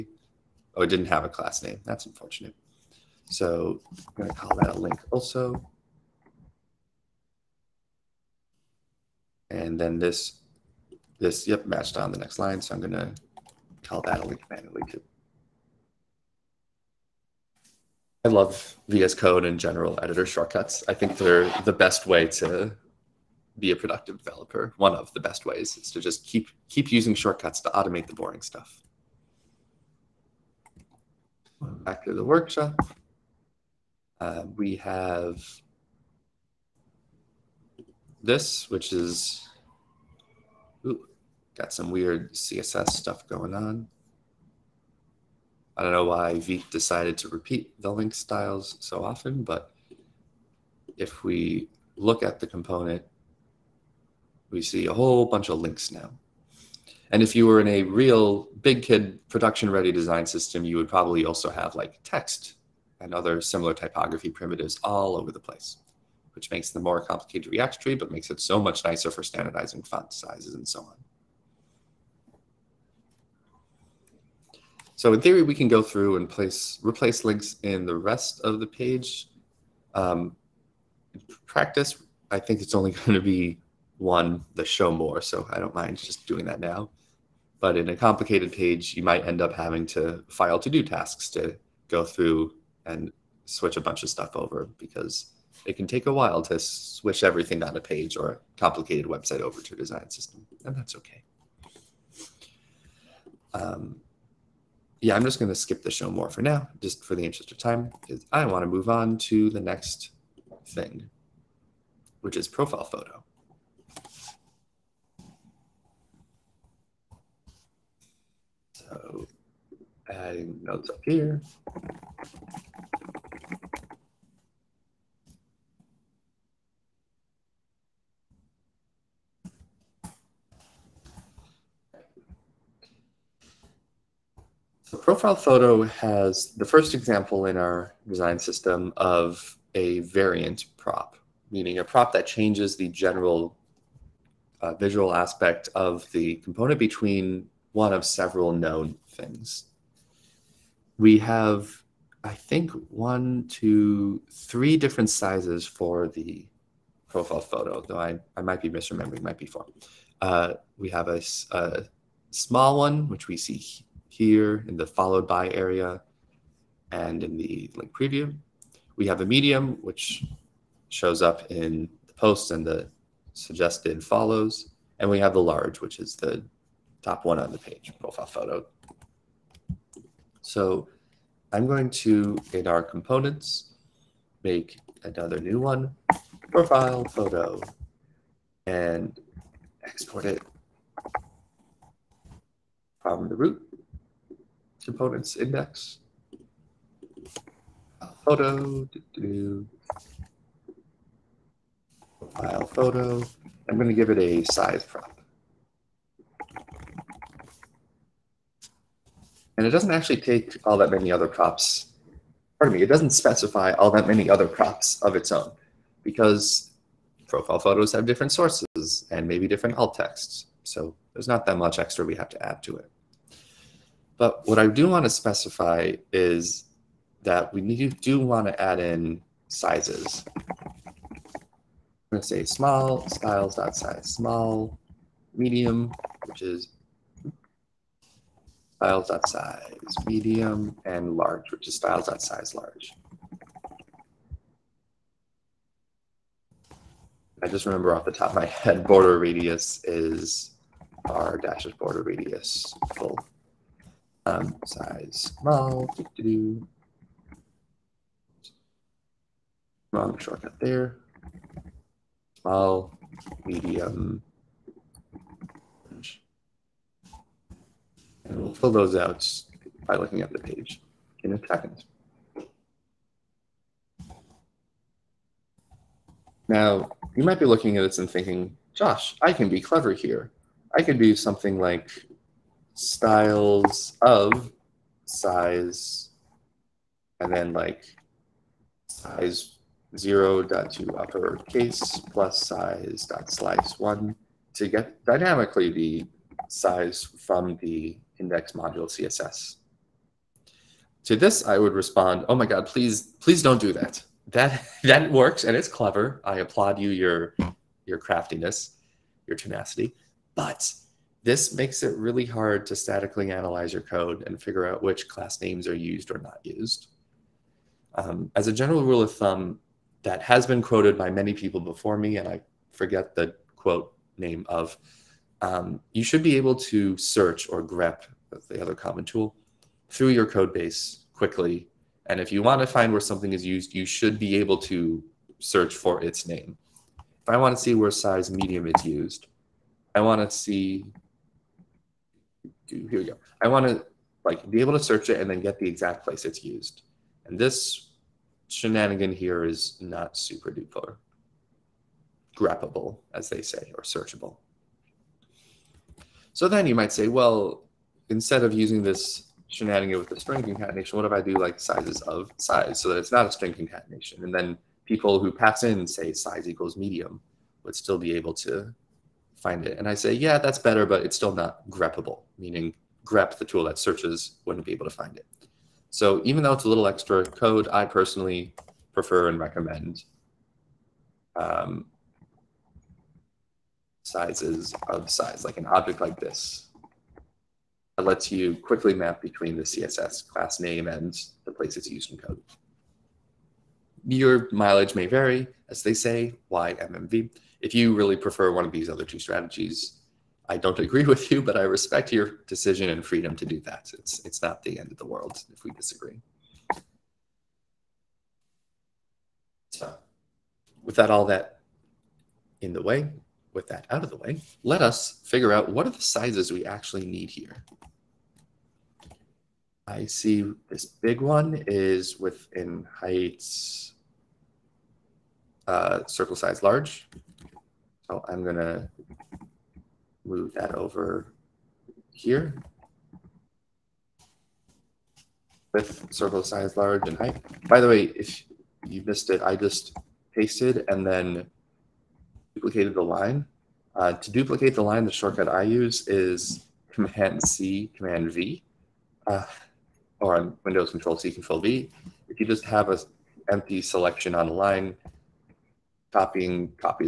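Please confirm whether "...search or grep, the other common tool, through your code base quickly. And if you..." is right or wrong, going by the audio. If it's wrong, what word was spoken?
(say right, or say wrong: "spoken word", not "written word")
right.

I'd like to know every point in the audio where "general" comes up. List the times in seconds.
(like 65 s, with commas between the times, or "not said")
19 s, 142 s, 318 s.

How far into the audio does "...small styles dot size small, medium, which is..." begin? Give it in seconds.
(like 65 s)
232 s.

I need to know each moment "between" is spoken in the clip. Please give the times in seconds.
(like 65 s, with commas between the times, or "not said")
146 s, 389 s.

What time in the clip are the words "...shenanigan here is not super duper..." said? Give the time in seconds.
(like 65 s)
348 s.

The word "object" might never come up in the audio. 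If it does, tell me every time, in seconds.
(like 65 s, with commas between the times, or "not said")
385 s.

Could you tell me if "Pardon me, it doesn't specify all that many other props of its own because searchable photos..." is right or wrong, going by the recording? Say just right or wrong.
wrong.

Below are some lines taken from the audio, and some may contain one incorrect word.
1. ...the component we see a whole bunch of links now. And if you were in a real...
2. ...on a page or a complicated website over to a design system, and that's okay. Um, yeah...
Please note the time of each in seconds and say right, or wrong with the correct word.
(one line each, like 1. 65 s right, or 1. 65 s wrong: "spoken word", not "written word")
1. 52 s right
2. 97 s right.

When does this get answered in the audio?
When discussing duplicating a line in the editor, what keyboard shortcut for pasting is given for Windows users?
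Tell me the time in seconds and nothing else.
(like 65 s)
451 s.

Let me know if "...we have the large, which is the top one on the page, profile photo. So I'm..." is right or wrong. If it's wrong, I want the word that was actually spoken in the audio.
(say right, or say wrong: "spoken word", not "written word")
right.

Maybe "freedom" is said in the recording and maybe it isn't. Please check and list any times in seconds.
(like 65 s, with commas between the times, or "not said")
403 s.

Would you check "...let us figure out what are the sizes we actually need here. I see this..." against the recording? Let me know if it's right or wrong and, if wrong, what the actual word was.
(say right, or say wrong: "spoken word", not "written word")
right.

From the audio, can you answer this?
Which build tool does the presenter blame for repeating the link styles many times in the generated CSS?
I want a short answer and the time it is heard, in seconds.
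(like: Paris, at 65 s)
Vite, at 46 s.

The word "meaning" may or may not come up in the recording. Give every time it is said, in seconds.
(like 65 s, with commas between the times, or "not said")
141 s, 372 s.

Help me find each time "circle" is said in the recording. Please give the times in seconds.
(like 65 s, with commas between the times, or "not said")
426 s, 436 s.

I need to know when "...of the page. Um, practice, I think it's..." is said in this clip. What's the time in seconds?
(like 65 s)
78 s.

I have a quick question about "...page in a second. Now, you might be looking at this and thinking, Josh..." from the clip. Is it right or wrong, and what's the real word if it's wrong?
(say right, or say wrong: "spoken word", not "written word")
right.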